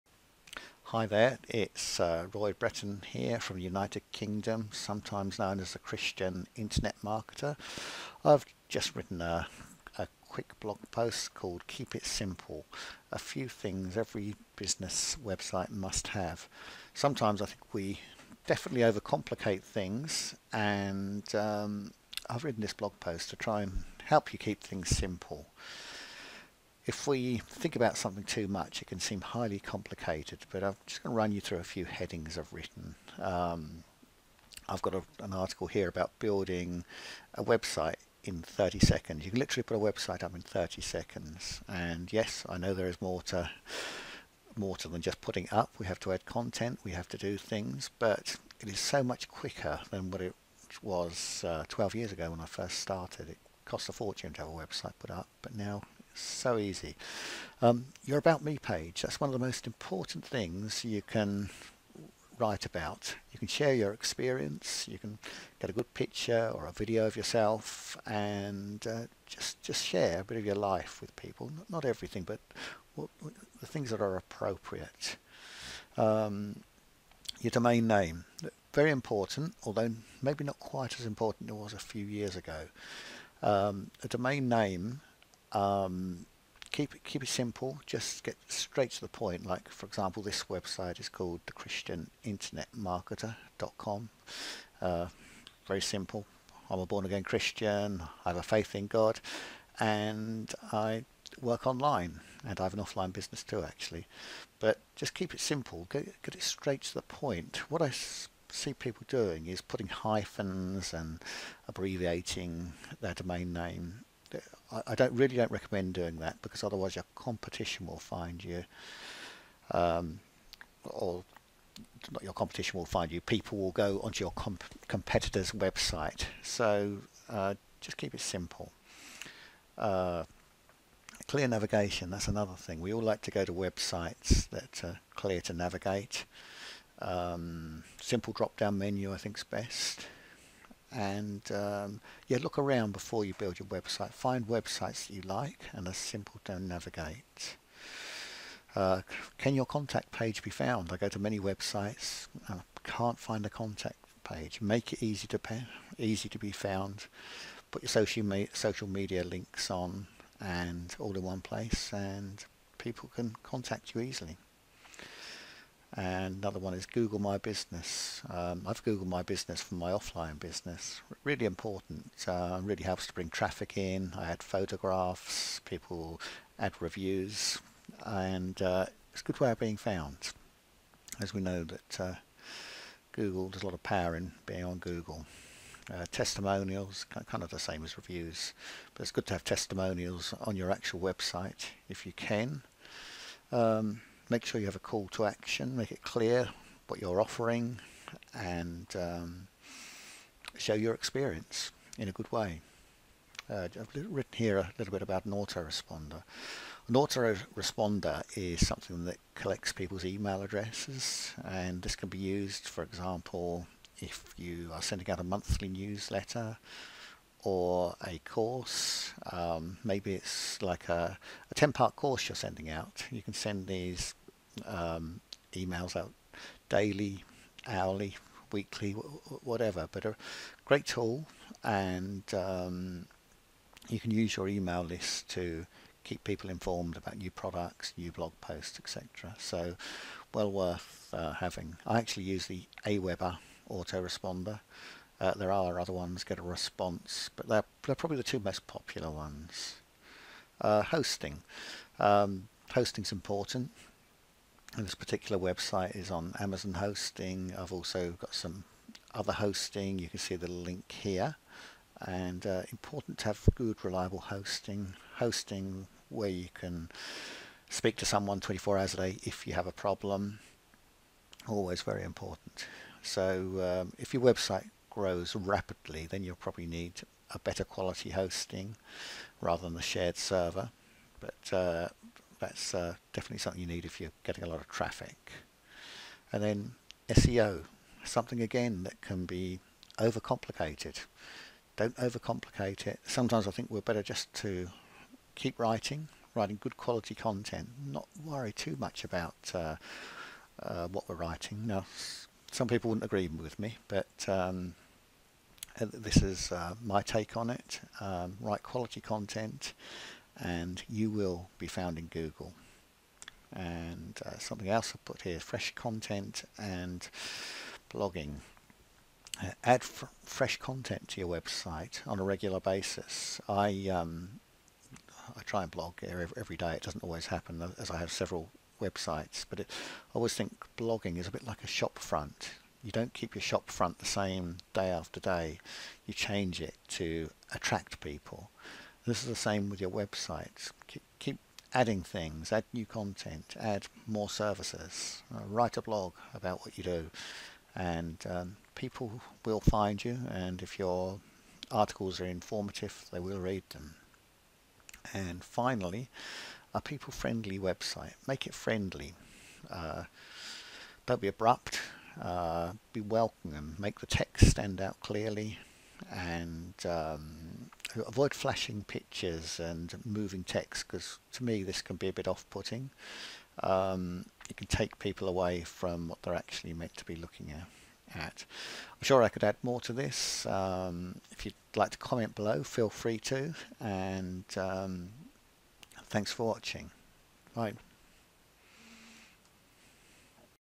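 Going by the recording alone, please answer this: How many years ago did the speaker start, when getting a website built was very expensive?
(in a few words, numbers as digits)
12.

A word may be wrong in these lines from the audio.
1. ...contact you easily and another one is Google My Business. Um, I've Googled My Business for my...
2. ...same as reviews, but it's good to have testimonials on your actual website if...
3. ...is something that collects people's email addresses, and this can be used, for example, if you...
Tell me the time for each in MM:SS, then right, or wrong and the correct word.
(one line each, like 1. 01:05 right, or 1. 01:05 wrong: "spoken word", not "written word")
1. 02:43 right
2. 03:07 right
3. 03:28 right.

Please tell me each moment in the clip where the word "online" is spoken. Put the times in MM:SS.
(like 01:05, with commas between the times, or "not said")
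01:41.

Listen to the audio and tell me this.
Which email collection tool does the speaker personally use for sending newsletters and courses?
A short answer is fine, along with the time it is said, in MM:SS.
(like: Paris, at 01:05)
Aweber, at 04:02.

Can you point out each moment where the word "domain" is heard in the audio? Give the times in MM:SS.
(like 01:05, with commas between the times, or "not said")
01:17, 01:24, 01:53.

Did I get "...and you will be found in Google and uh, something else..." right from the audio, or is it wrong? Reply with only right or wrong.
right.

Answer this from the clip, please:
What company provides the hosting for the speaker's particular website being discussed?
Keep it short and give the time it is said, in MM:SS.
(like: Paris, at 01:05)
Amazon, at 04:16.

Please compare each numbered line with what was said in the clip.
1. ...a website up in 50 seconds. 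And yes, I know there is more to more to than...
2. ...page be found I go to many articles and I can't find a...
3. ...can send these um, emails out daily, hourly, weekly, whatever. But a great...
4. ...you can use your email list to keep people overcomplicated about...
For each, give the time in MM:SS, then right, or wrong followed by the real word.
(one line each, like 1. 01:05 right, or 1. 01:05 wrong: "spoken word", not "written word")
1. 00:39 wrong: "30", not "50"
2. 02:30 wrong: "websites", not "articles"
3. 03:43 right
4. 03:53 wrong: "informed", not "overcomplicated".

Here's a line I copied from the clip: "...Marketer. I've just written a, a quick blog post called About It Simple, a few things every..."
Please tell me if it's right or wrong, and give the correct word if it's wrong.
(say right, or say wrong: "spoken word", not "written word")
wrong: "Keep", not "About".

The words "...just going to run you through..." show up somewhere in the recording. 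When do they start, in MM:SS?
00:30.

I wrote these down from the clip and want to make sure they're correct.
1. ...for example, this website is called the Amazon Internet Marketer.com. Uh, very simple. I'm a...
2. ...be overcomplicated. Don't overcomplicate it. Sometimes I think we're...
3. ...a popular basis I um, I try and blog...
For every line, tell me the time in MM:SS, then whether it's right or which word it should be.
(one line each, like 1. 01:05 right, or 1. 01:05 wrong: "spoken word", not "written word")
1. 01:29 wrong: "Christian", not "Amazon"
2. 04:49 right
3. 05:22 wrong: "regular", not "popular".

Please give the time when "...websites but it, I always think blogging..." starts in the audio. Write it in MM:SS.
05:28.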